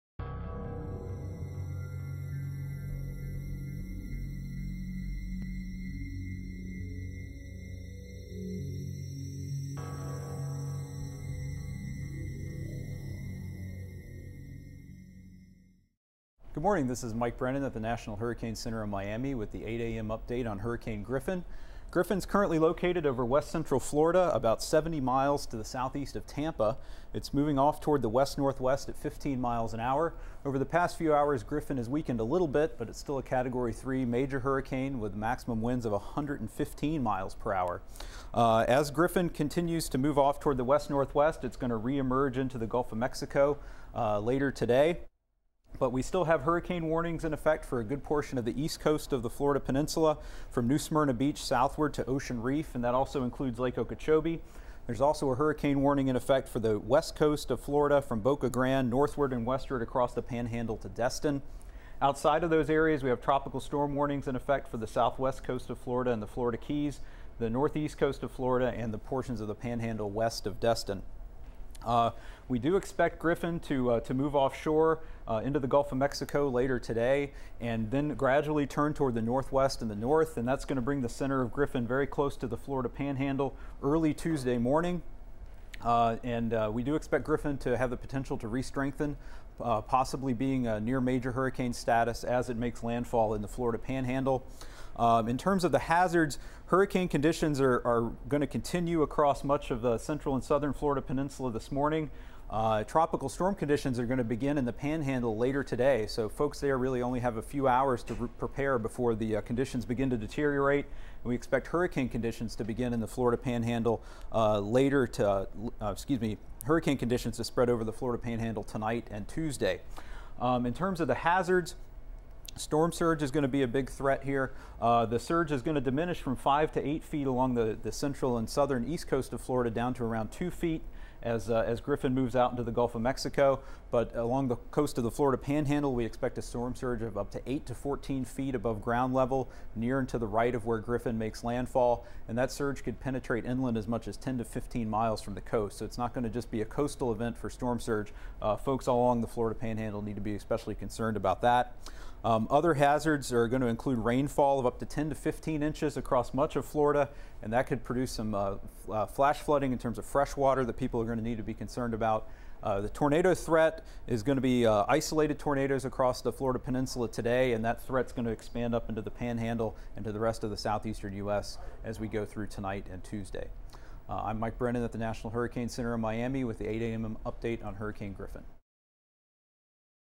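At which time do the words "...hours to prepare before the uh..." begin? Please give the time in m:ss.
1:47.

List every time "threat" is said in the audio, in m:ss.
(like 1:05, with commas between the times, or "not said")
2:03, 2:43, 2:47.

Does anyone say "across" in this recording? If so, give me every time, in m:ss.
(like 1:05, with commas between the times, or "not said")
0:59, 1:39, 2:35, 2:45.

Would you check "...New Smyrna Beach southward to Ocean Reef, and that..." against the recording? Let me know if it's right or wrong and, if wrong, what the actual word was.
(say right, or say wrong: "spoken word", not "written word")
right.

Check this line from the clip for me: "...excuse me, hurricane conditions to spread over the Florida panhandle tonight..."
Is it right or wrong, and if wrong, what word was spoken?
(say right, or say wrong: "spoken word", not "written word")
right.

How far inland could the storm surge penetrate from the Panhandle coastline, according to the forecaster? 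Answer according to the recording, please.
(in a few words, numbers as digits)
10 to 15 miles.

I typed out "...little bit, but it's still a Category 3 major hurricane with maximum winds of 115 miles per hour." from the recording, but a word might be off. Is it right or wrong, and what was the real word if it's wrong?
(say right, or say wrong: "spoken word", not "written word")
right.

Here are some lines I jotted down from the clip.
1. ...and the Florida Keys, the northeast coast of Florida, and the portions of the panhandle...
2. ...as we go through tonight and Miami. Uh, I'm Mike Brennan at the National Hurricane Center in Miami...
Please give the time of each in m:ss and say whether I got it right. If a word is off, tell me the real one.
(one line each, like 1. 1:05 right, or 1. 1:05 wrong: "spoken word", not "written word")
1. 1:06 right
2. 2:51 wrong: "Tuesday", not "Miami".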